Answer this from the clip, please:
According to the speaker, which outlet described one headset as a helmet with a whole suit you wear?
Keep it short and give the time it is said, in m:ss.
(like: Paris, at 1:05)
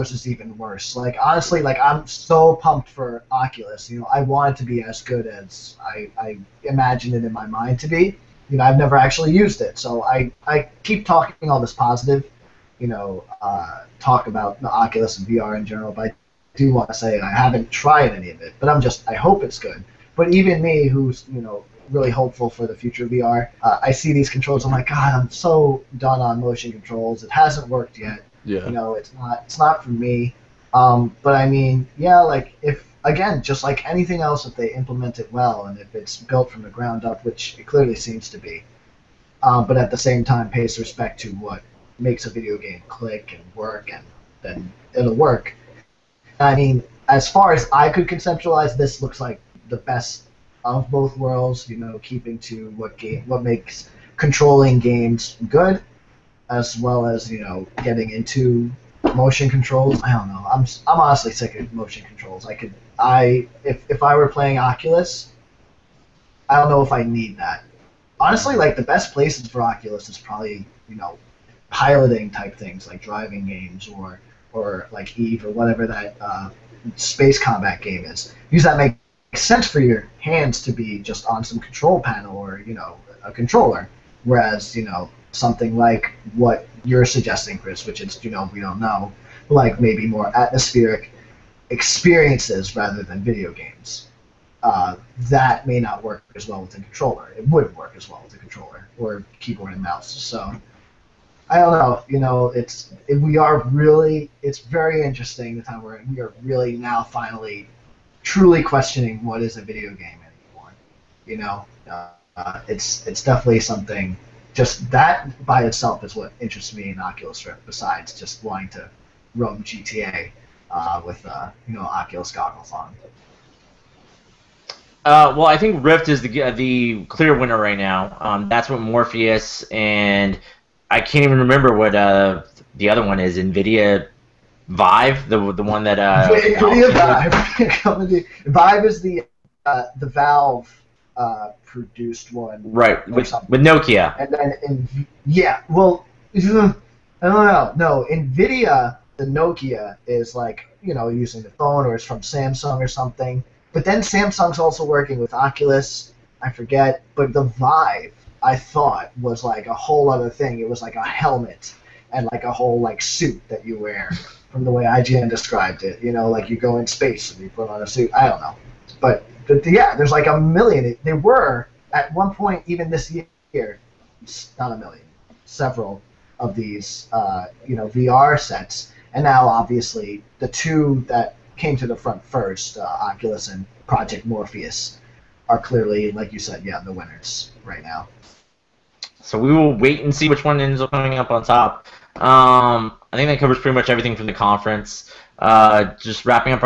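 IGN, at 2:44.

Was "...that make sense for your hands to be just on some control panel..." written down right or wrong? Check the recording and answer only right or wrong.
right.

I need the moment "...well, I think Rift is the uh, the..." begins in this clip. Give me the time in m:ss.
2:05.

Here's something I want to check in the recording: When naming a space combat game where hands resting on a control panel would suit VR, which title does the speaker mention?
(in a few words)
Eve.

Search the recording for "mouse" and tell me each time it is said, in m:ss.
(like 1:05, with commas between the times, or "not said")
1:39.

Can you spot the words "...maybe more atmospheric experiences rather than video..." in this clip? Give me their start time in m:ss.
1:29.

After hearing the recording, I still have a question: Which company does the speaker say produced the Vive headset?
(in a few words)
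Valve.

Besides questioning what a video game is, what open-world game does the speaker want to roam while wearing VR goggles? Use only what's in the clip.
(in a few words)
GTA.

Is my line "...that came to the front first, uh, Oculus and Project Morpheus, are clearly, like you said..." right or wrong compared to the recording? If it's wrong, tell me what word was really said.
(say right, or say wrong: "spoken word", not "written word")
right.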